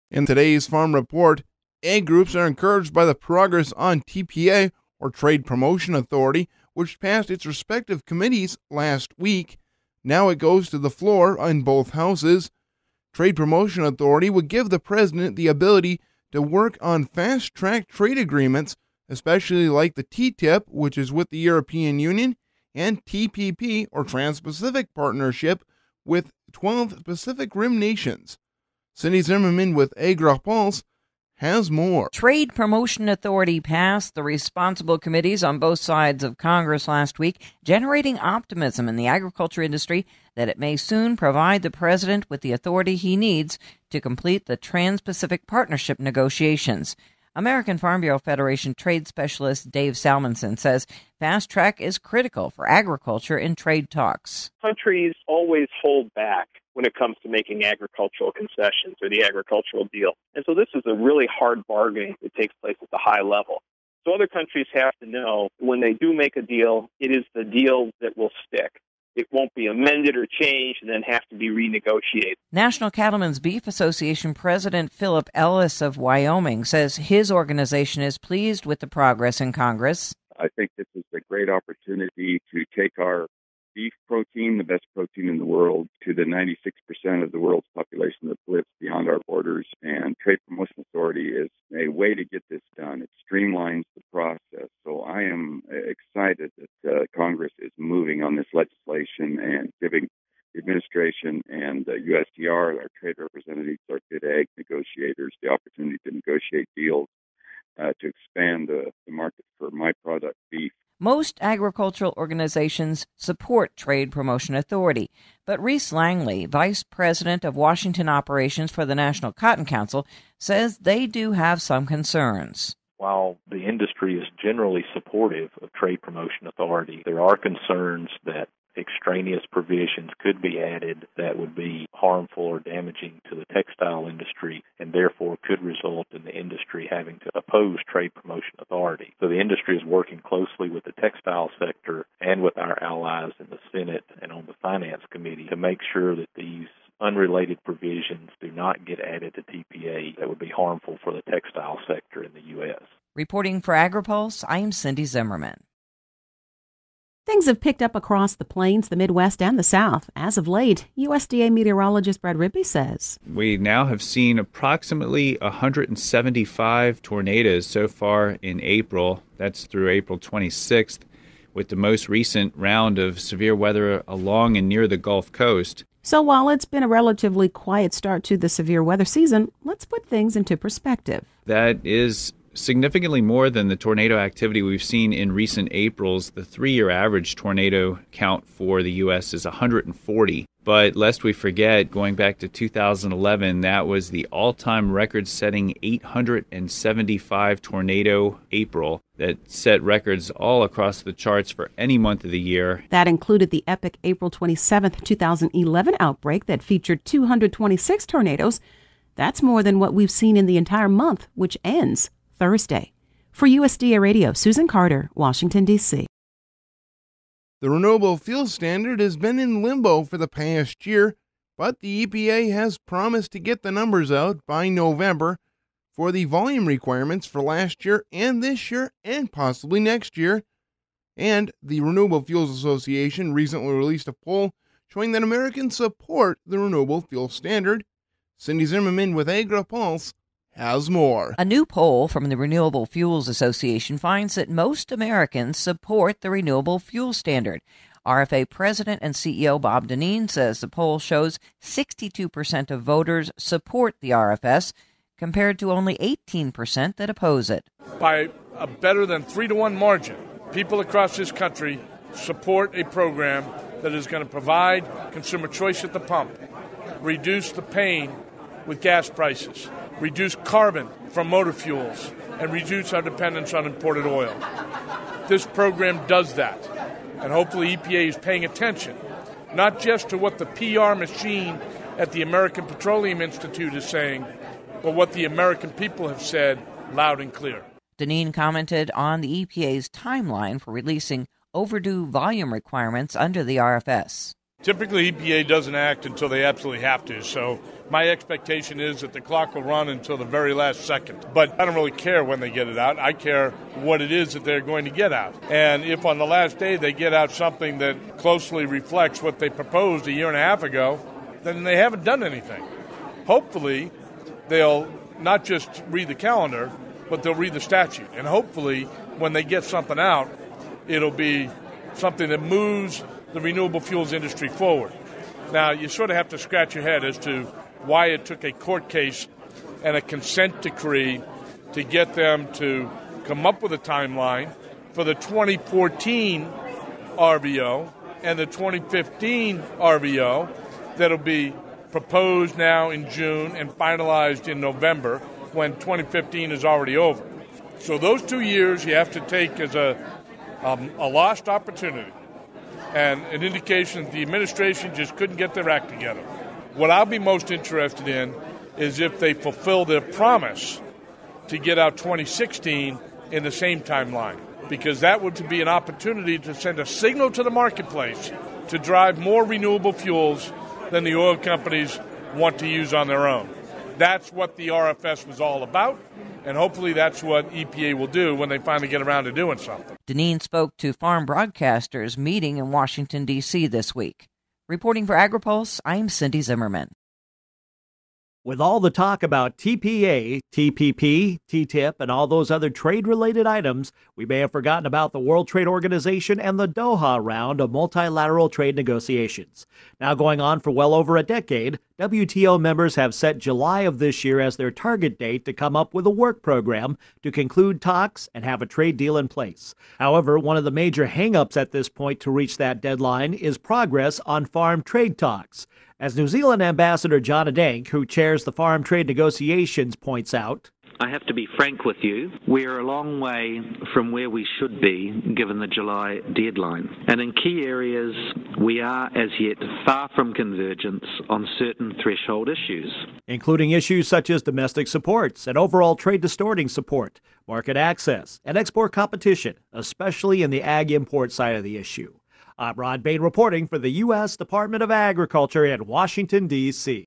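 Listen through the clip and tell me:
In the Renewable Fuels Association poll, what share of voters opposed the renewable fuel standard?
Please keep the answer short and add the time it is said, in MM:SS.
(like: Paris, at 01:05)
18%, at 04:15.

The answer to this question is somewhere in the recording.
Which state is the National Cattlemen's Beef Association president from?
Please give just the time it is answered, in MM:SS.
01:15.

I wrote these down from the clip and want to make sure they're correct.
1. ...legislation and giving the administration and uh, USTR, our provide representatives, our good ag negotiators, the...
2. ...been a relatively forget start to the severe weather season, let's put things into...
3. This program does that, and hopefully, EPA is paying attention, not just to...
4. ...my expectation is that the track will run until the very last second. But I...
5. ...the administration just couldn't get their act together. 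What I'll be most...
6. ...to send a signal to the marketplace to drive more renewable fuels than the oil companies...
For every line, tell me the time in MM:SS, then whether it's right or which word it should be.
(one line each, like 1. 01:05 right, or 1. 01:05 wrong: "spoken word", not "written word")
1. 01:38 wrong: "trade", not "provide"
2. 02:56 wrong: "quiet", not "forget"
3. 04:35 right
4. 04:57 wrong: "clock", not "track"
5. 05:54 right
6. 06:06 right.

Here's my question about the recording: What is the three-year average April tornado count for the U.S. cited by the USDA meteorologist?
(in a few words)
140.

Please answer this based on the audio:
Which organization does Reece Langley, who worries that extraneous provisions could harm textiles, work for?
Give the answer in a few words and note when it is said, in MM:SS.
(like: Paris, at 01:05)
National Cotton Council, at 01:58.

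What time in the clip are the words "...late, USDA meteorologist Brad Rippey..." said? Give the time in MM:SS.
02:40.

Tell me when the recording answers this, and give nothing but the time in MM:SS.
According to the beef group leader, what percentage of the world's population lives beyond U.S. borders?
01:26.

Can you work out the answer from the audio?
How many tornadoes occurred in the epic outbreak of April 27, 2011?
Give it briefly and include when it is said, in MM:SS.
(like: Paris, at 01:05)
226, at 03:27.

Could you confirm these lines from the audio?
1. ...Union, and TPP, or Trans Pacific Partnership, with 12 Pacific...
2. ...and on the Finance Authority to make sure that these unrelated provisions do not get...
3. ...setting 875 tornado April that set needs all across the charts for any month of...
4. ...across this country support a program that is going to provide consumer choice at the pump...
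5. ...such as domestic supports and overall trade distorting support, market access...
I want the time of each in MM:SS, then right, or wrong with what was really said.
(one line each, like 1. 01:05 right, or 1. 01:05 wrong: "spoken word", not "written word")
1. 00:21 right
2. 02:24 wrong: "Committee", not "Authority"
3. 03:15 wrong: "records", not "needs"
4. 04:20 right
5. 07:14 right.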